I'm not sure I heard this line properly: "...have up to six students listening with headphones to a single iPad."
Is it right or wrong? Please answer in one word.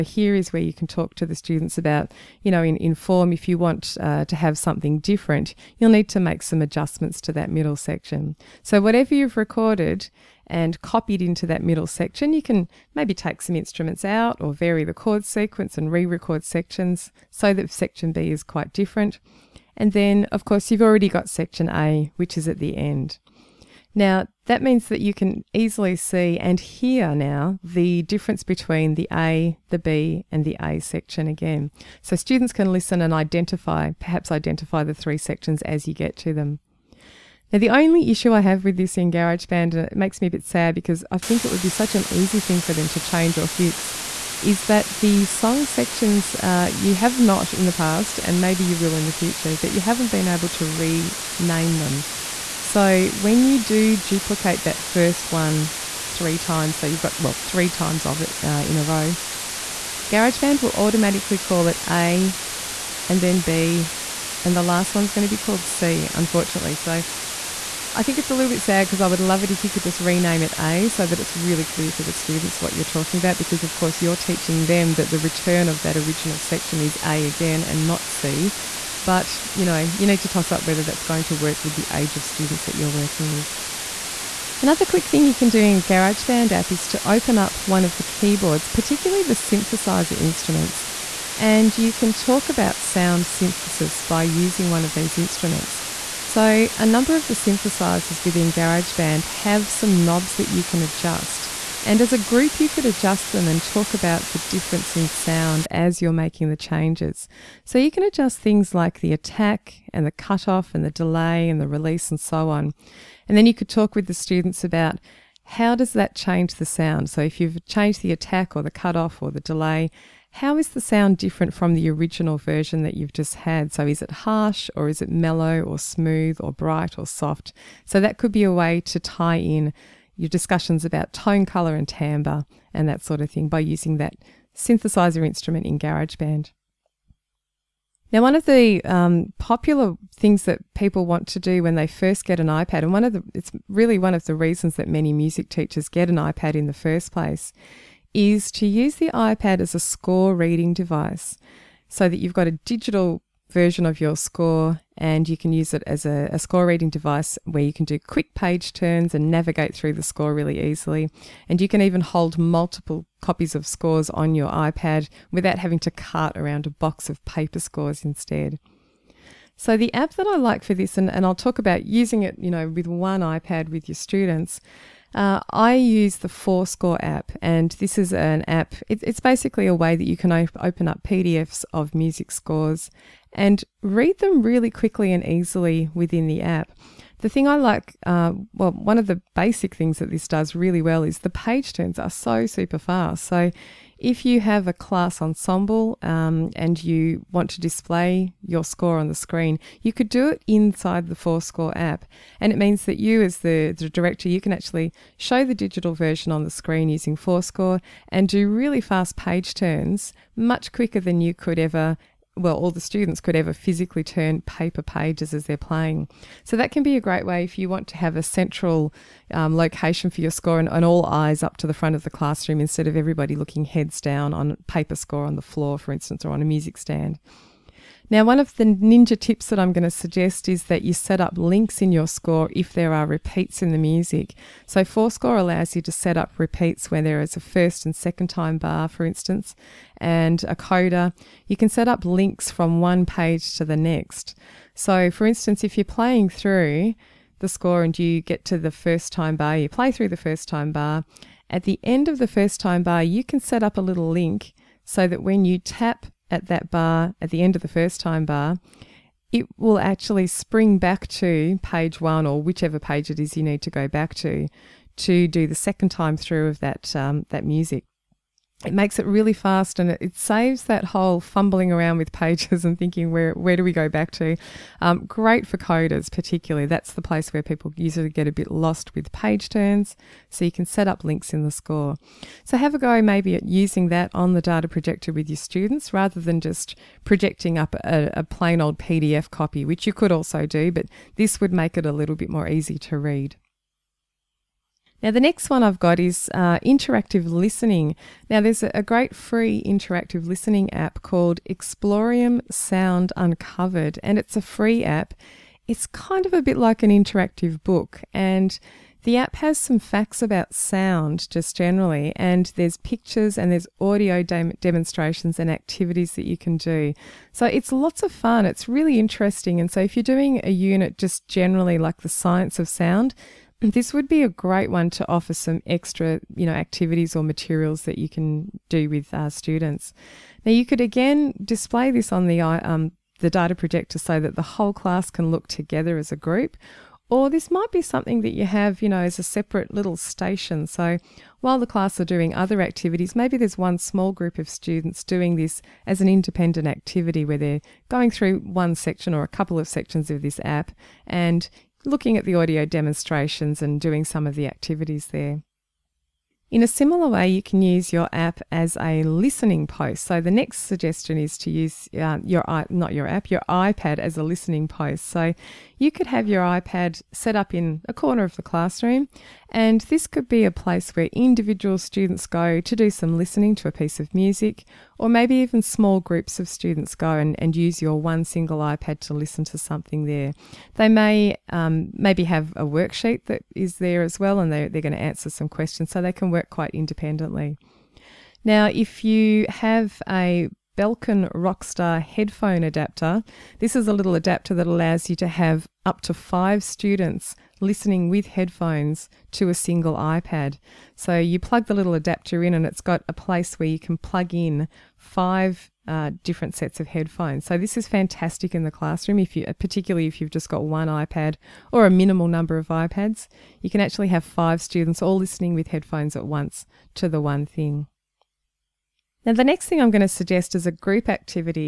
wrong.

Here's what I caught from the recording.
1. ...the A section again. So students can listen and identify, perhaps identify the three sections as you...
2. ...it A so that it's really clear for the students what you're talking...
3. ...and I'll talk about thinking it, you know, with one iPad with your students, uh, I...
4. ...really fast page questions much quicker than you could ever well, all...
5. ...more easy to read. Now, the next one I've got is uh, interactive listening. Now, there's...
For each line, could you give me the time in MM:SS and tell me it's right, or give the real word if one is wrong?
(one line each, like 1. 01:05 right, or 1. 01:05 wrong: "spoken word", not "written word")
1. 00:30 right
2. 01:10 right
3. 02:51 wrong: "using", not "thinking"
4. 03:28 wrong: "turns", not "questions"
5. 04:52 right.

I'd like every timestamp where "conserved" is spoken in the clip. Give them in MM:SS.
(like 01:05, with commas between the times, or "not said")
not said.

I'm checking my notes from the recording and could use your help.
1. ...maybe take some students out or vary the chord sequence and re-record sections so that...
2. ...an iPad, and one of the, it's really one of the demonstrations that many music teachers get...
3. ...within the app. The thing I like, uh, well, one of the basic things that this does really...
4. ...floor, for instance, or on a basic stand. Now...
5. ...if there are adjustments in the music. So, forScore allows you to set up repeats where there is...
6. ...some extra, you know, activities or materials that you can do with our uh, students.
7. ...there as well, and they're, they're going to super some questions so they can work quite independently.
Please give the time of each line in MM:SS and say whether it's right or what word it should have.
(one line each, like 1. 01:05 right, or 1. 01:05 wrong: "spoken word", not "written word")
1. 00:12 wrong: "instruments", not "students"
2. 02:22 wrong: "reasons", not "demonstrations"
3. 03:05 right
4. 03:45 wrong: "music", not "basic"
5. 03:52 wrong: "repeats", not "adjustments"
6. 05:25 right
7. 06:23 wrong: "answer", not "super".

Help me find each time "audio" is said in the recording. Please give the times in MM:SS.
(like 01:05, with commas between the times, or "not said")
05:13, 05:52.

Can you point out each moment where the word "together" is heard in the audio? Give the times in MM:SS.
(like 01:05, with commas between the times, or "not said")
05:35.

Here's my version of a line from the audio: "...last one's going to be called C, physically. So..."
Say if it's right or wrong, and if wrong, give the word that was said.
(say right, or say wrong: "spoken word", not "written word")
wrong: "unfortunately", not "physically".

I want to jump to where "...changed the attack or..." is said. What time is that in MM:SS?
01:57.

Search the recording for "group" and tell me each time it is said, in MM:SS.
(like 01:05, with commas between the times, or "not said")
01:42, 05:36, 05:44, 06:15, 07:00.